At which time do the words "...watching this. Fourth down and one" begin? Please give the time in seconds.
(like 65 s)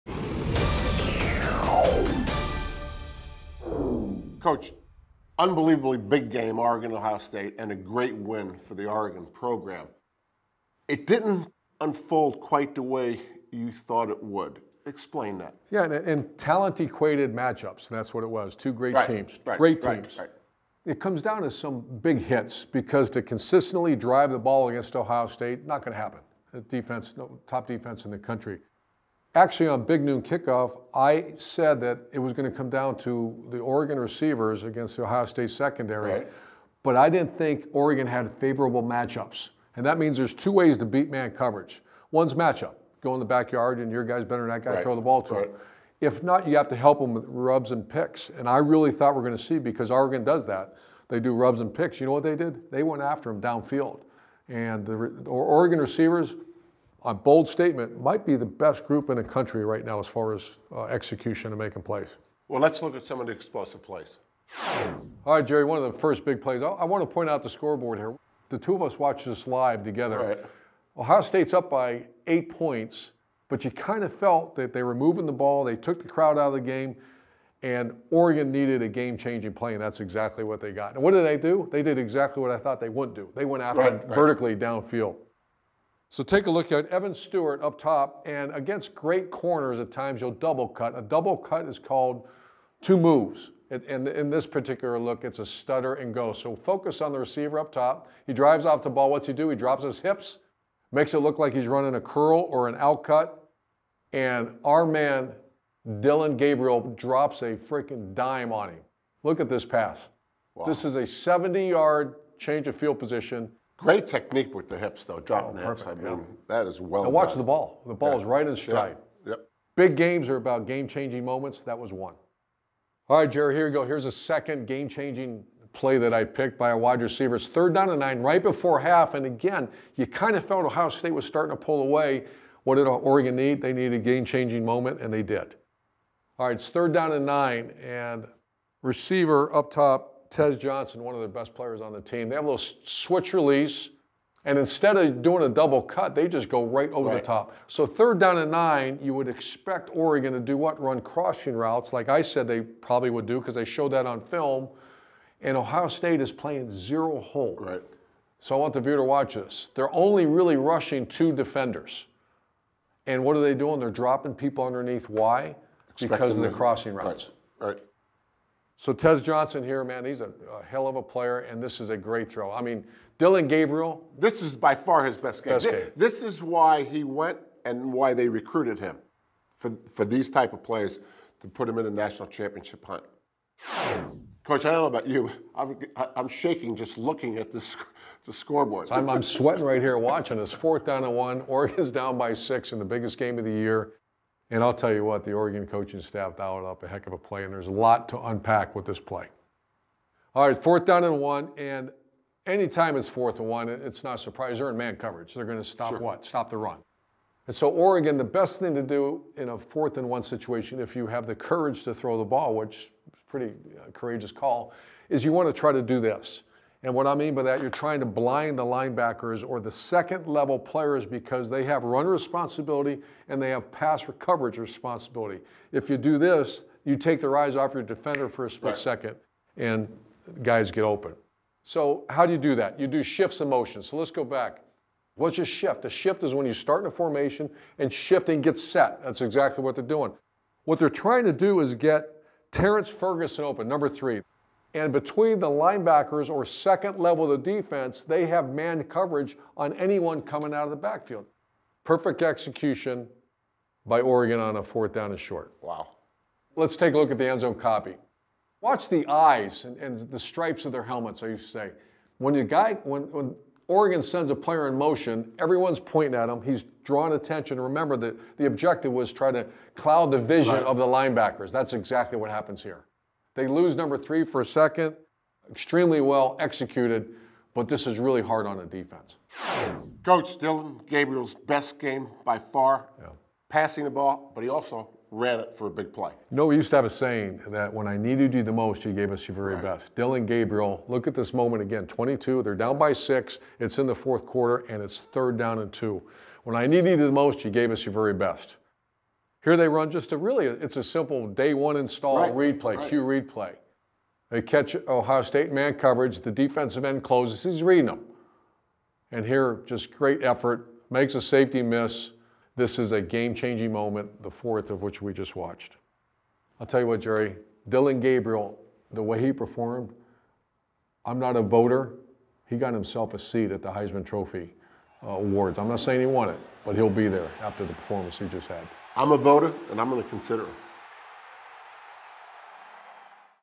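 189 s.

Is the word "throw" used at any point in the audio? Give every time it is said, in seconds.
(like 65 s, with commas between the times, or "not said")
44 s, 172 s, 211 s.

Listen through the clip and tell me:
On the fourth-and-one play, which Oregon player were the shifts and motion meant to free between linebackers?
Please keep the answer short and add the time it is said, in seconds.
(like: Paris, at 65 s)
Terrence Ferguson, at 242 s.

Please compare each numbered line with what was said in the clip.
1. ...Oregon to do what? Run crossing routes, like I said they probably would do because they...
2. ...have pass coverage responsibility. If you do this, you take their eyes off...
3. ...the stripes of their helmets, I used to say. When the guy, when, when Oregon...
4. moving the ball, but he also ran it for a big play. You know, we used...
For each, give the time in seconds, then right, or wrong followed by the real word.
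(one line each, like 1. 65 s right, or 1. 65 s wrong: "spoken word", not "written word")
1. 149 s right
2. 223 s right
3. 260 s right
4. 283 s wrong: "passing", not "moving".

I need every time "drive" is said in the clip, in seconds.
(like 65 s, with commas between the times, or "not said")
23 s, 98 s.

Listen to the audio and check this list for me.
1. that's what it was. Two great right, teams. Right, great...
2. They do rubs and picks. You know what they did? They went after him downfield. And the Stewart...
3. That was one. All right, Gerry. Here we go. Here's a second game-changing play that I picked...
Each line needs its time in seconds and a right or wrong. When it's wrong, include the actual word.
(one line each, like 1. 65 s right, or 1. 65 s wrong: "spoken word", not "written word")
1. 17 s right
2. 51 s wrong: "Oregon", not "Stewart"
3. 121 s right.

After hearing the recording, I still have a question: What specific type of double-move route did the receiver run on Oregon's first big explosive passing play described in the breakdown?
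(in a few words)
stutter and go.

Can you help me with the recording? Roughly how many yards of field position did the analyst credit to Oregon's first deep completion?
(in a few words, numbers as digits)
70.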